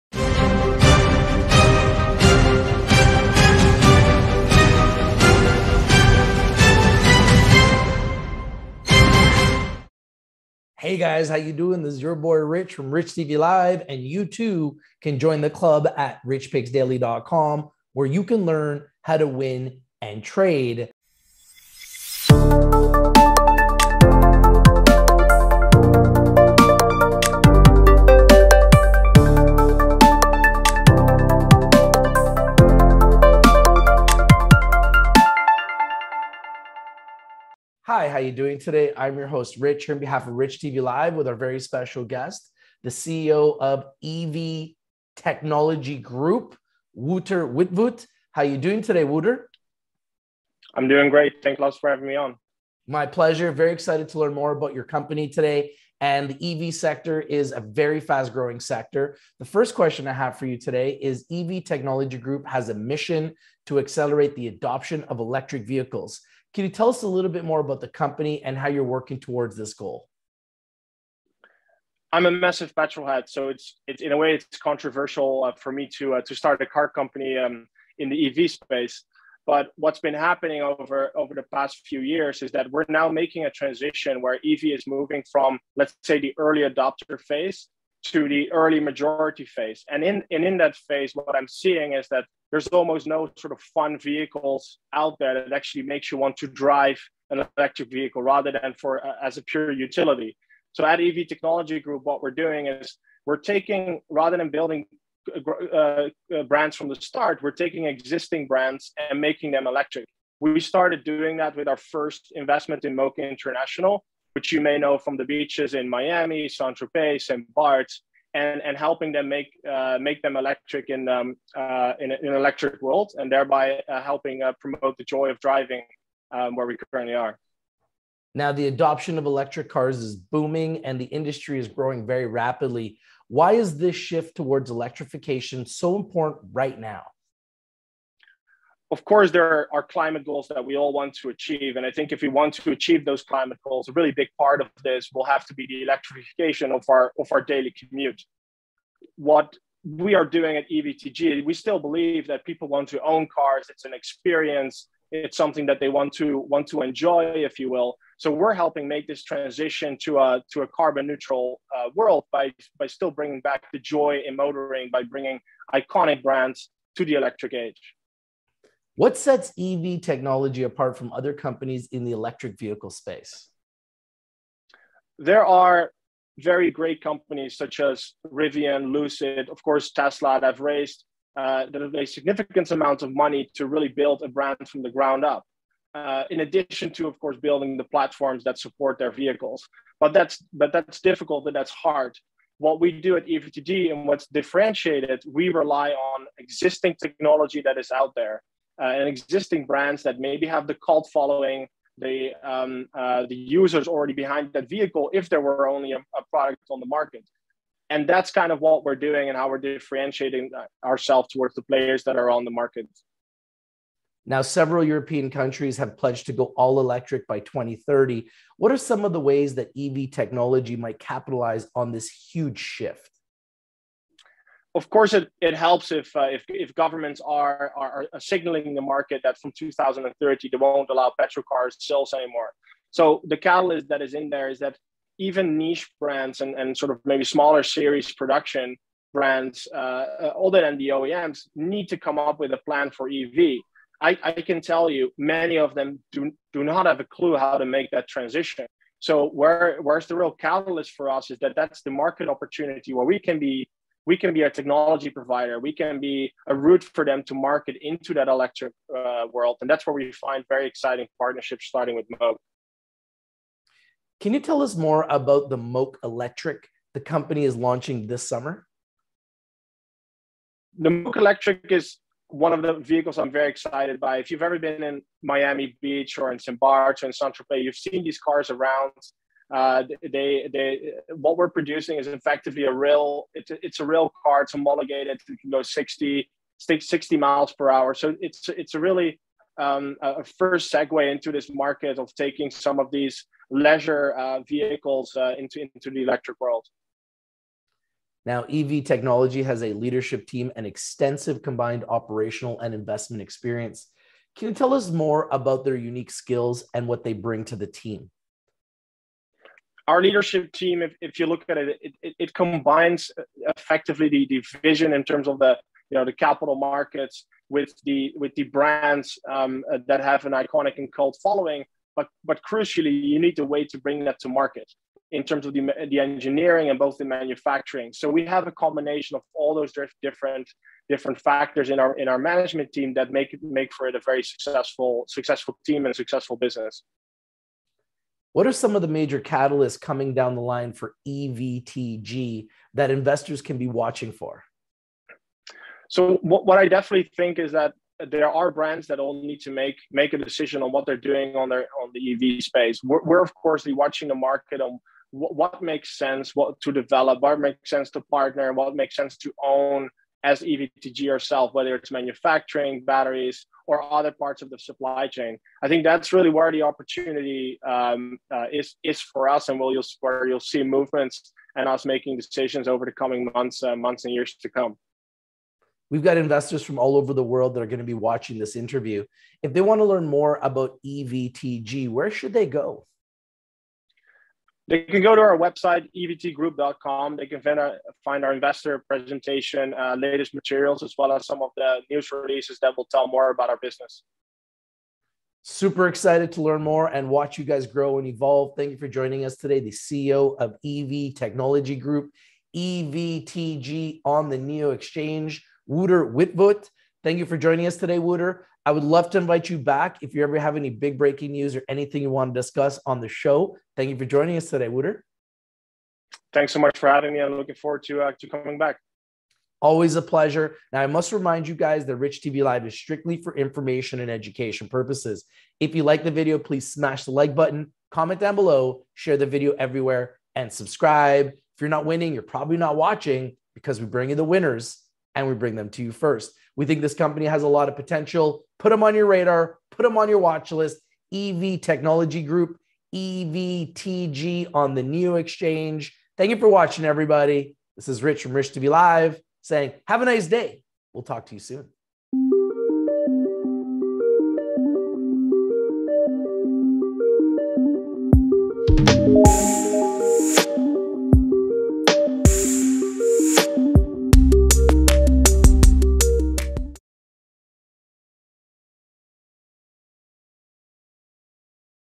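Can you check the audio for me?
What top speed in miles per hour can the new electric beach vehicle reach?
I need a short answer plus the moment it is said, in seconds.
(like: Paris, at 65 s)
60, at 286 s.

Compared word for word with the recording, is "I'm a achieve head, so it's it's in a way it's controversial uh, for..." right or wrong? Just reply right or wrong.
wrong.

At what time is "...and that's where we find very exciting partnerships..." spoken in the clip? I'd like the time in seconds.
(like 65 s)
259 s.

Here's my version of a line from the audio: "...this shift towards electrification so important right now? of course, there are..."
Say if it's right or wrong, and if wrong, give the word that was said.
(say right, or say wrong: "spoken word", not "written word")
right.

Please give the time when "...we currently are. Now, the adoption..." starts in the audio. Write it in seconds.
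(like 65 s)
126 s.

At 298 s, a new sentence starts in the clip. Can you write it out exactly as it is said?
Now, EV Technology has a leadership team and extensive combined operational and investment experience.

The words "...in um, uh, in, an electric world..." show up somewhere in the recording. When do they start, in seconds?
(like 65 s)
120 s.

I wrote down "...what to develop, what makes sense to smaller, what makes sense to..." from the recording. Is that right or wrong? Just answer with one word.
wrong.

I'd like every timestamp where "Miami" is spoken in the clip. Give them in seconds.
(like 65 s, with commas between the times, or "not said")
115 s, 275 s.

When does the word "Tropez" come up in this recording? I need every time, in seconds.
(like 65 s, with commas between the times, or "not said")
116 s, 277 s.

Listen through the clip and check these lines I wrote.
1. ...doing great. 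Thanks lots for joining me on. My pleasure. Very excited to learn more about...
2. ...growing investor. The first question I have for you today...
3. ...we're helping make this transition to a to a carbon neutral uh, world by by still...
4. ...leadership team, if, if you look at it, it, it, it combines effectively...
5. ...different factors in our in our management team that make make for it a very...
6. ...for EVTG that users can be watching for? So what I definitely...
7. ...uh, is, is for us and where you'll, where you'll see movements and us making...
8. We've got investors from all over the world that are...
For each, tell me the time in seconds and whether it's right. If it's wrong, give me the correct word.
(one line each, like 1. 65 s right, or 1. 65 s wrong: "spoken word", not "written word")
1. 50 s wrong: "having", not "joining"
2. 58 s wrong: "sector", not "investor"
3. 158 s right
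4. 310 s right
5. 330 s right
6. 340 s wrong: "investors", not "users"
7. 368 s right
8. 375 s right.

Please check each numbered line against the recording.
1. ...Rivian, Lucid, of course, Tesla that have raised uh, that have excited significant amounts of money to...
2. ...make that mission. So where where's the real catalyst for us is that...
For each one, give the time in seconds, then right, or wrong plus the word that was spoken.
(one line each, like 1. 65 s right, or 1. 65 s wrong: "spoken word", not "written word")
1. 178 s wrong: "raised", not "excited"
2. 247 s wrong: "transition", not "mission".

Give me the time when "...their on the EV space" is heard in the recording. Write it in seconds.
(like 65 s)
351 s.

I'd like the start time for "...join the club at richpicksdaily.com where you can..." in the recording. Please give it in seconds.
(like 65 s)
15 s.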